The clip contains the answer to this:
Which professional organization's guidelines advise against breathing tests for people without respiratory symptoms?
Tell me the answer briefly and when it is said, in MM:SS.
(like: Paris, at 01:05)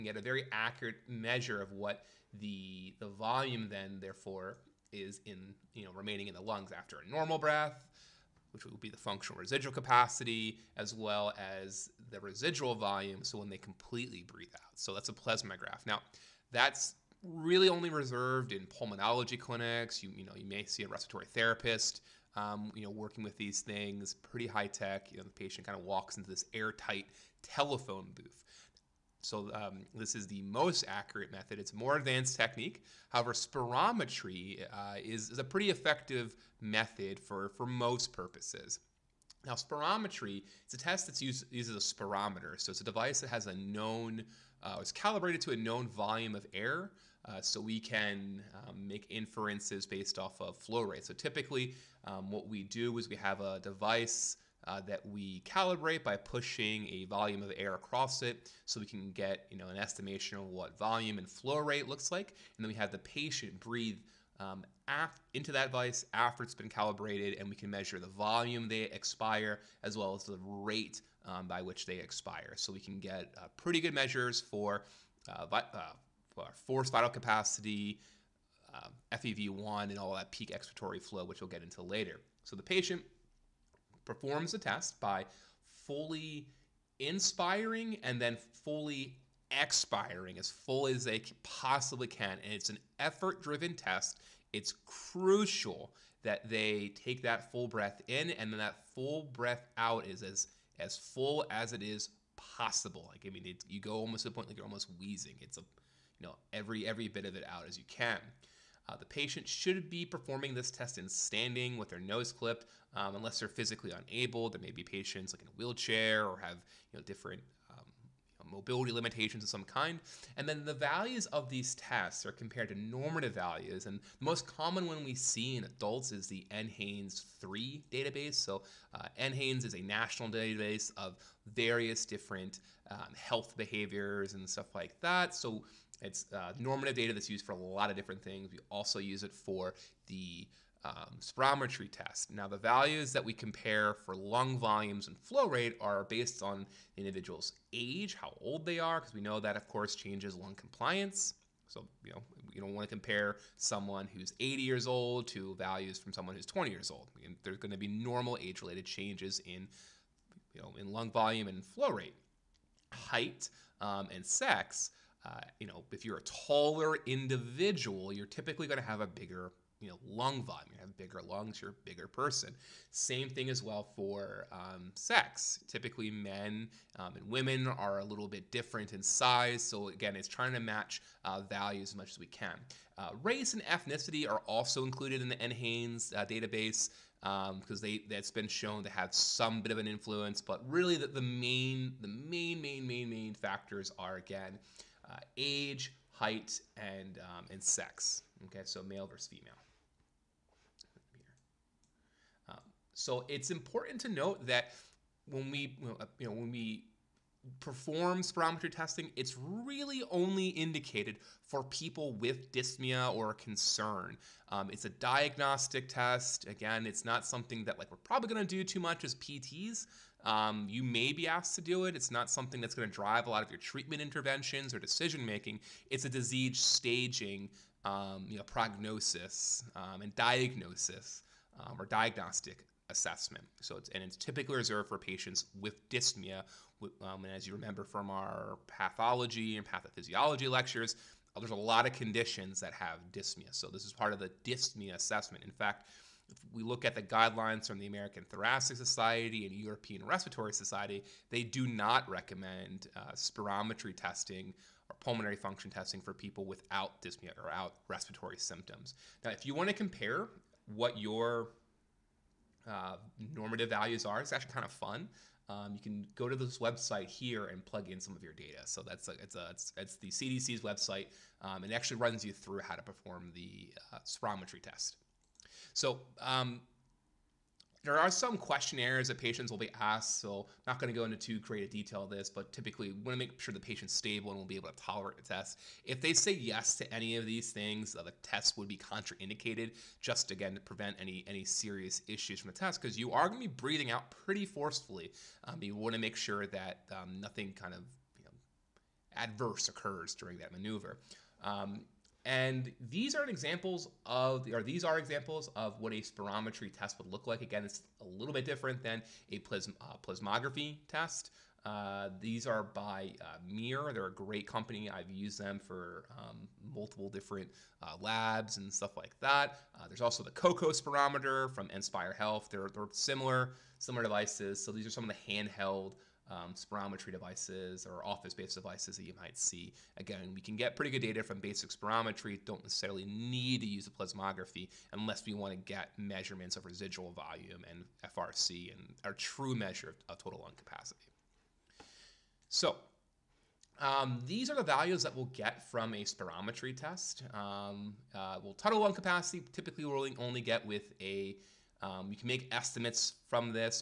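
American Thoracic Society, at 04:07.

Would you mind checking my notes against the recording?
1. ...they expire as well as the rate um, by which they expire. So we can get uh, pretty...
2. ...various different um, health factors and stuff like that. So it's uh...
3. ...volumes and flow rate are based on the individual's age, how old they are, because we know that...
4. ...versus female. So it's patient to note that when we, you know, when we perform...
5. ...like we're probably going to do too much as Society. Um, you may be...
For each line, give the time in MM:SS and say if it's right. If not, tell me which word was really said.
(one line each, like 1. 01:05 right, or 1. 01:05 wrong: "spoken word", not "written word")
1. 01:08 right
2. 02:11 wrong: "behaviors", not "factors"
3. 02:24 right
4. 03:19 wrong: "important", not "patient"
5. 03:37 wrong: "PTs", not "Society".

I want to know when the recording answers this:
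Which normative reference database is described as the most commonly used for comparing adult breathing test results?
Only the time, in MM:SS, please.
02:06.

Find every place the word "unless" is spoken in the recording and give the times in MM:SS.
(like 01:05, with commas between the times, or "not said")
01:53, 05:34.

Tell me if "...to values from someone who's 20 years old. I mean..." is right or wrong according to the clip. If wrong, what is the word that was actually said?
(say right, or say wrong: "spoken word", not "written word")
right.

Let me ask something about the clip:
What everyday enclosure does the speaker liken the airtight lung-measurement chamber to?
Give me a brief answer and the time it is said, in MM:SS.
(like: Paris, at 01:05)
telephone booth, at 00:27.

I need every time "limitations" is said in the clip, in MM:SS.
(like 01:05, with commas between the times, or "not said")
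01:58.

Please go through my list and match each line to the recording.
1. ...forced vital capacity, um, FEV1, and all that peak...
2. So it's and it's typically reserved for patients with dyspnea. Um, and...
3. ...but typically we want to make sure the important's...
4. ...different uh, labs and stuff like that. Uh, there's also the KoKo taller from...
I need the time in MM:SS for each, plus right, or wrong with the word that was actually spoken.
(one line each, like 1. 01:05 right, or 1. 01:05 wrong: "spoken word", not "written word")
1. 01:16 right
2. 03:53 right
3. 04:42 wrong: "patient", not "important"
4. 05:17 wrong: "spirometer", not "taller".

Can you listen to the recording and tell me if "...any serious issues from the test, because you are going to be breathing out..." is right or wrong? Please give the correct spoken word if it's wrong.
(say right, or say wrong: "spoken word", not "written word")
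right.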